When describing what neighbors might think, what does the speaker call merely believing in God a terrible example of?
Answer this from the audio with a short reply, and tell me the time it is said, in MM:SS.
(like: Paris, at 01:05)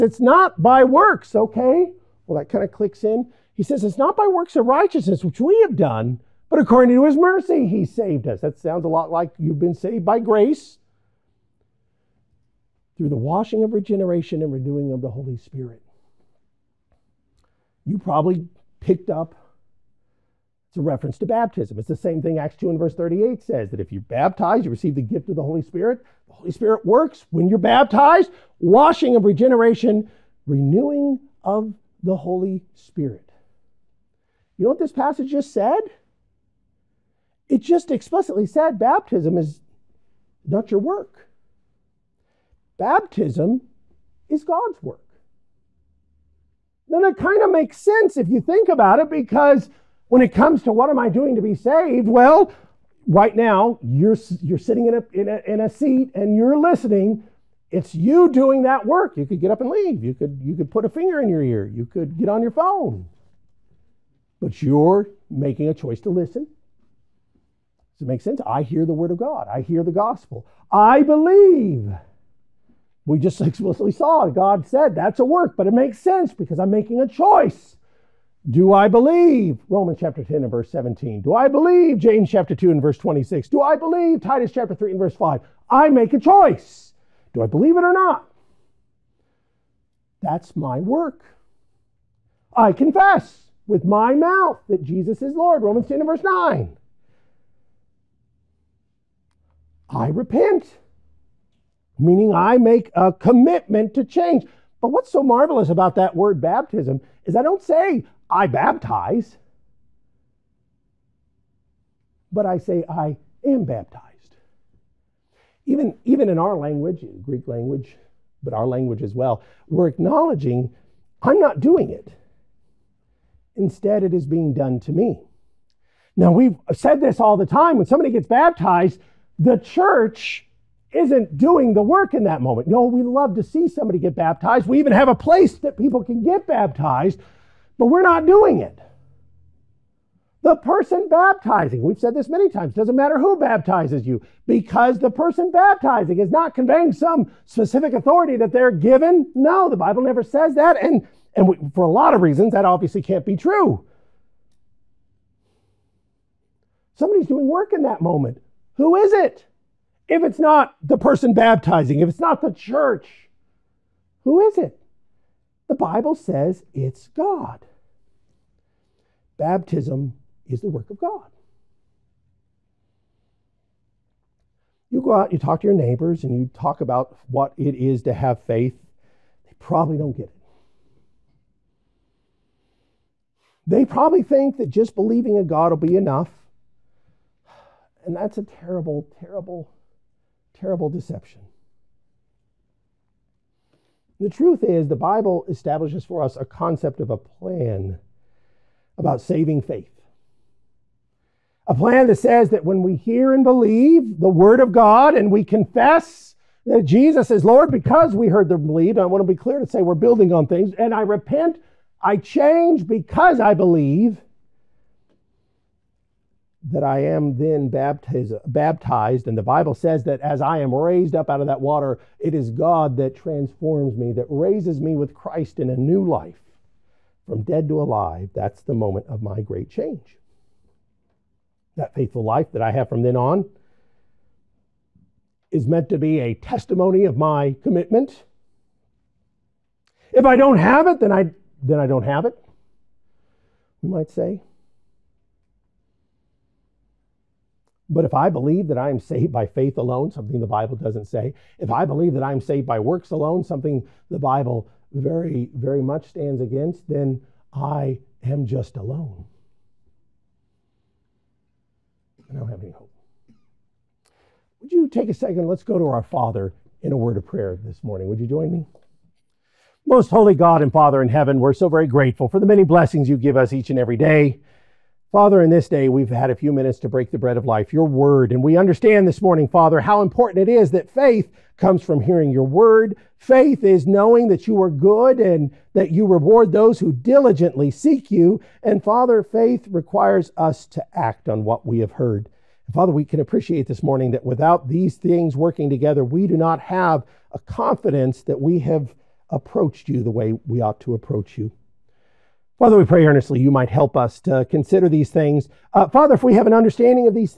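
Deception, at 03:10.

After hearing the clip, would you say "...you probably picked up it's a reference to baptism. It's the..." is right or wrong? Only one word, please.
right.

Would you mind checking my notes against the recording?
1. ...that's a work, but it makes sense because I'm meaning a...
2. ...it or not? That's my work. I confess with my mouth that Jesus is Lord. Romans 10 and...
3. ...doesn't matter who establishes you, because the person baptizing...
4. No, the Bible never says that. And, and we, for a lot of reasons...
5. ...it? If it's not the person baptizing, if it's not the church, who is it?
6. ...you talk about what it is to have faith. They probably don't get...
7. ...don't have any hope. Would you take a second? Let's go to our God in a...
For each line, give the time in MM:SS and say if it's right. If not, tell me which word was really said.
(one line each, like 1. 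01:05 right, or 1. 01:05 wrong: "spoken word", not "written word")
1. 01:14 wrong: "making", not "meaning"
2. 01:27 right
3. 02:22 wrong: "baptizes", not "establishes"
4. 02:29 right
5. 02:39 right
6. 02:56 right
7. 04:22 wrong: "Father", not "God".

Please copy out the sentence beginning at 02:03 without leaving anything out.
Instead, it is being done to me.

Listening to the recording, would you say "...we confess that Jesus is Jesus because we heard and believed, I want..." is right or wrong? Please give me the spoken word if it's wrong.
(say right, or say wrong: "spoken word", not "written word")
wrong: "Lord", not "Jesus".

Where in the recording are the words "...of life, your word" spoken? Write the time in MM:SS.
04:37.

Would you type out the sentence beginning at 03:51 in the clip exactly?
That faithful life that I have from then on is meant to be a testimony of my commitment.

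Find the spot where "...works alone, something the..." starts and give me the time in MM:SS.
04:12.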